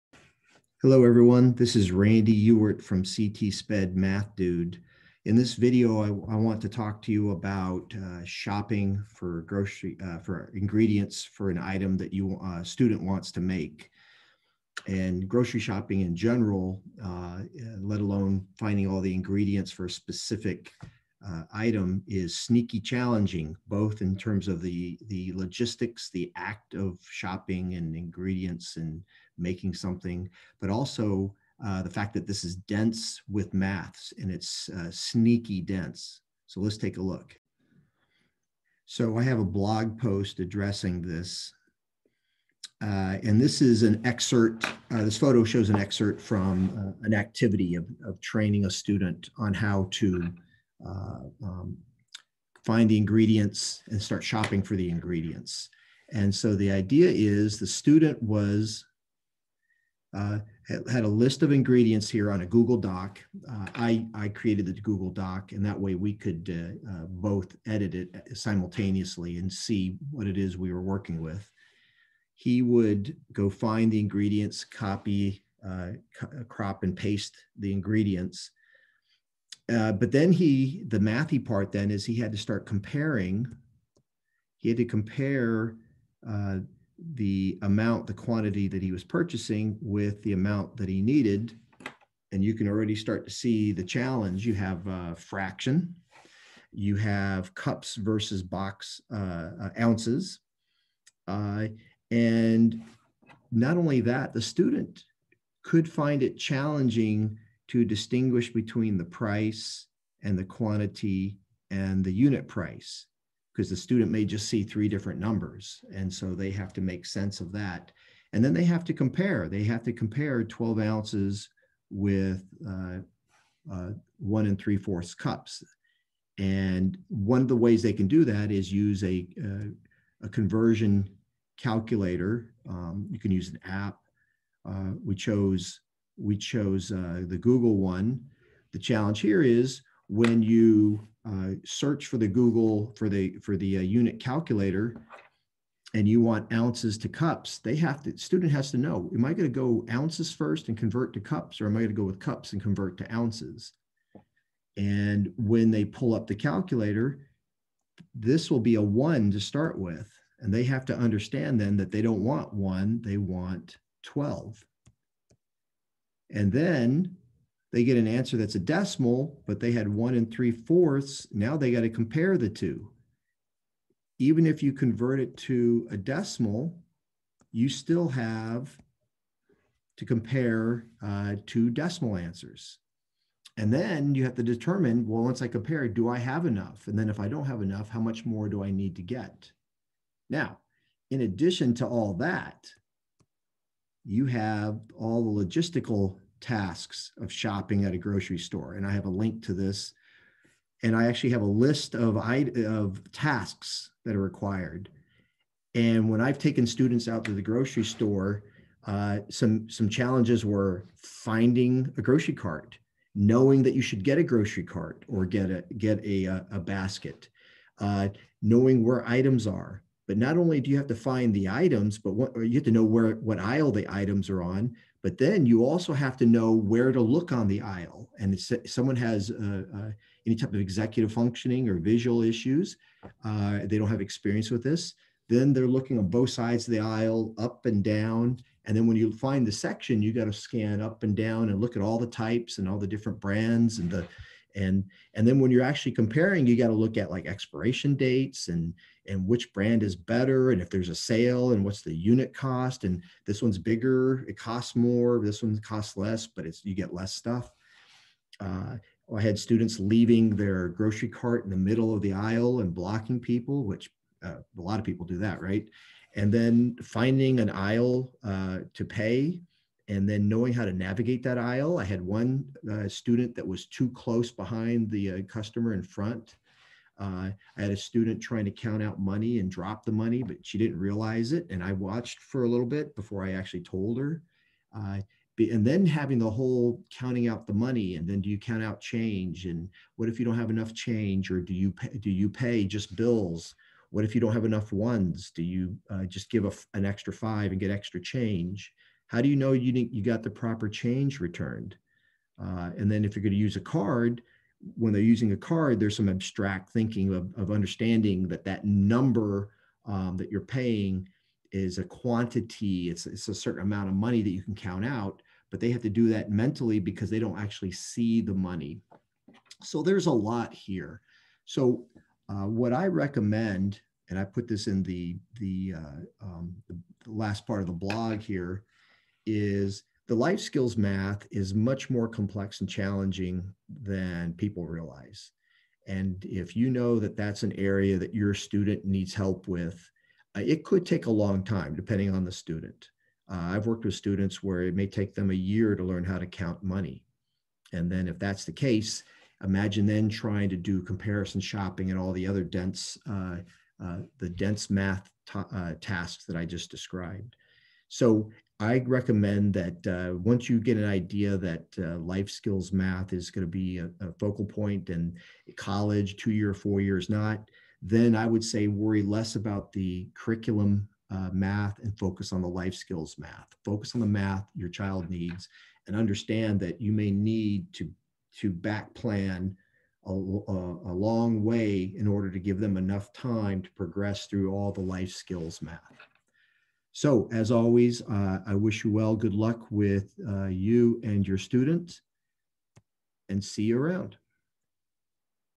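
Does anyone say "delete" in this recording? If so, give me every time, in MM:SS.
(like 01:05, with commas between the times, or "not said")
not said.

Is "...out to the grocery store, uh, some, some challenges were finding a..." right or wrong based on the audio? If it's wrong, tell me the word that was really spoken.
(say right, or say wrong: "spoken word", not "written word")
right.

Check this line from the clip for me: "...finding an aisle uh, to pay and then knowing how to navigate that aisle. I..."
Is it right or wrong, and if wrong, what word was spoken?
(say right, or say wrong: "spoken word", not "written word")
right.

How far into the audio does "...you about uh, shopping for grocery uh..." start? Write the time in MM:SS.
00:07.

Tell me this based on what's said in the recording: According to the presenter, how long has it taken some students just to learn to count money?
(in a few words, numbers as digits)
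a year.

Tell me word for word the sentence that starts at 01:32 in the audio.
And you can already start to see the challenge.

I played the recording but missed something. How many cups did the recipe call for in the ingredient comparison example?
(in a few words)
1 3/4 cups.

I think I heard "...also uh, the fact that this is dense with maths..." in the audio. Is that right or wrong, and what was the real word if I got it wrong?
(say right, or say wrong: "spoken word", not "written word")
right.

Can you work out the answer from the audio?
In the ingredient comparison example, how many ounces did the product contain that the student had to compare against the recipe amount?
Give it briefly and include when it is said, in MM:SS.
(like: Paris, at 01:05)
12 ounces, at 02:00.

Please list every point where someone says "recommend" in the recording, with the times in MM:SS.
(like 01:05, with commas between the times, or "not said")
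05:22, 05:58.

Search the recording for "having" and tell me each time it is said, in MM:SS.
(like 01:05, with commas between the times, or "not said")
04:45.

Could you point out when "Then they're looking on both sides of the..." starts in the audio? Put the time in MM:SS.
03:55.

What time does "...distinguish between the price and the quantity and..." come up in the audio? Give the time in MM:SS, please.
01:47.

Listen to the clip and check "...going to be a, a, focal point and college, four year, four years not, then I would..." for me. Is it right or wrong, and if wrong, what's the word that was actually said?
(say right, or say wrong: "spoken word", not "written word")
wrong: "two", not "four".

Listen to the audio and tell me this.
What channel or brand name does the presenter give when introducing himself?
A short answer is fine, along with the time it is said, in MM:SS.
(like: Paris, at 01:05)
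CT Sped Math Dude, at 00:03.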